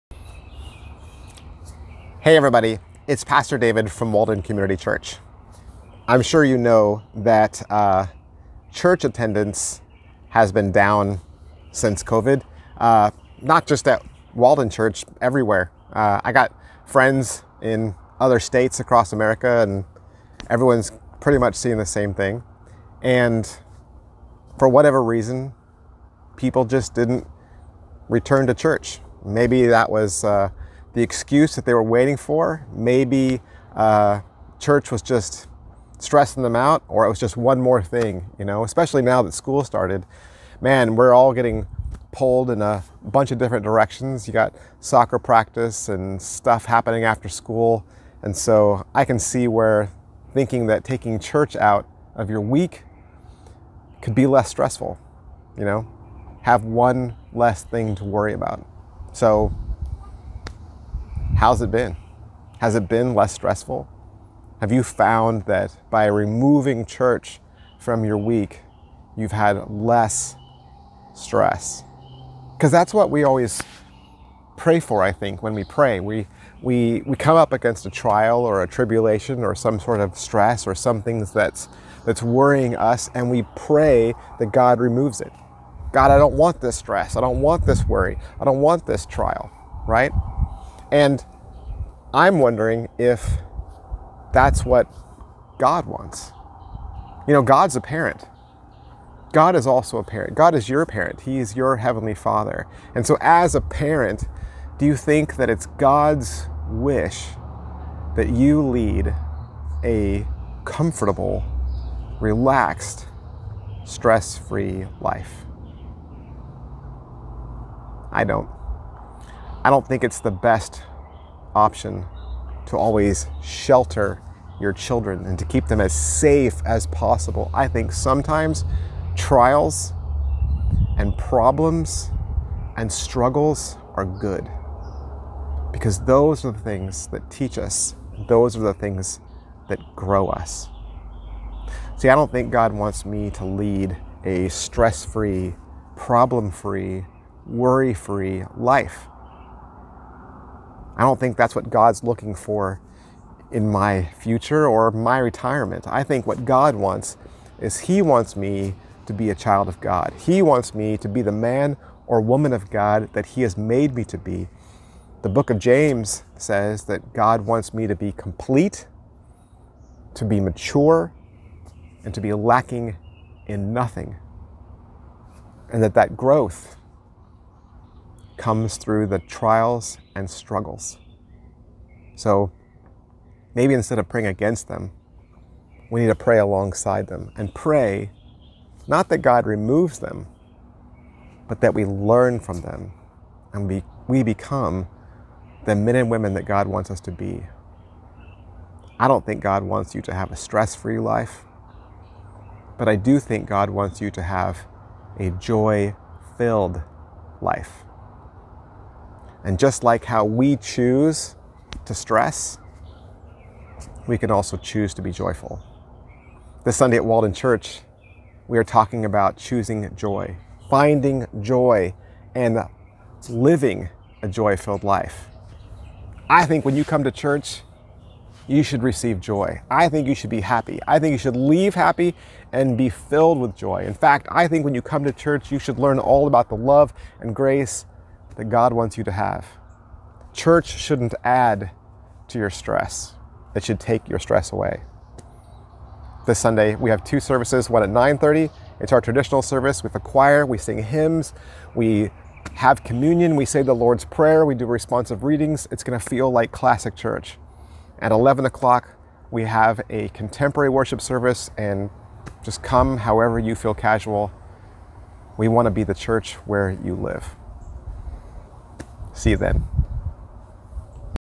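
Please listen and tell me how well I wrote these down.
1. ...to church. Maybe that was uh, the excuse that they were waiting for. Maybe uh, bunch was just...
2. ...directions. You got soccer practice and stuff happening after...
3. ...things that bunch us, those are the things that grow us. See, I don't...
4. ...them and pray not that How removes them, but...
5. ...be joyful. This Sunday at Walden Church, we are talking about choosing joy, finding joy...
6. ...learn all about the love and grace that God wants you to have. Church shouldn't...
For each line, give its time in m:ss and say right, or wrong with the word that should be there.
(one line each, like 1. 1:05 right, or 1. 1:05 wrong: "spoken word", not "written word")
1. 0:28 wrong: "church", not "bunch"
2. 0:43 right
3. 2:16 wrong: "teach", not "bunch"
4. 3:07 wrong: "God", not "How"
5. 3:35 right
6. 3:55 right.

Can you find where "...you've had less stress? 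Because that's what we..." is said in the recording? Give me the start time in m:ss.
1:09.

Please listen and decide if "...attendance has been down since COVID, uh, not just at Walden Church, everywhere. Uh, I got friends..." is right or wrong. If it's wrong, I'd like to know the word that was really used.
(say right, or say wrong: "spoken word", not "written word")
right.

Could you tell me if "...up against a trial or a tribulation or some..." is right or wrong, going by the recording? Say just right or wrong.
right.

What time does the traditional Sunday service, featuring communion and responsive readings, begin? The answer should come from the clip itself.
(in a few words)
9:30.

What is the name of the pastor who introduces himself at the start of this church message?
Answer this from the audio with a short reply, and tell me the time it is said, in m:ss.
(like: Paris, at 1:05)
David, at 0:03.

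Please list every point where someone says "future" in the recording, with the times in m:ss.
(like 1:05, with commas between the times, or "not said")
2:34.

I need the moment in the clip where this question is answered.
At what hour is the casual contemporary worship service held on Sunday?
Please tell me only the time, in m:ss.
4:18.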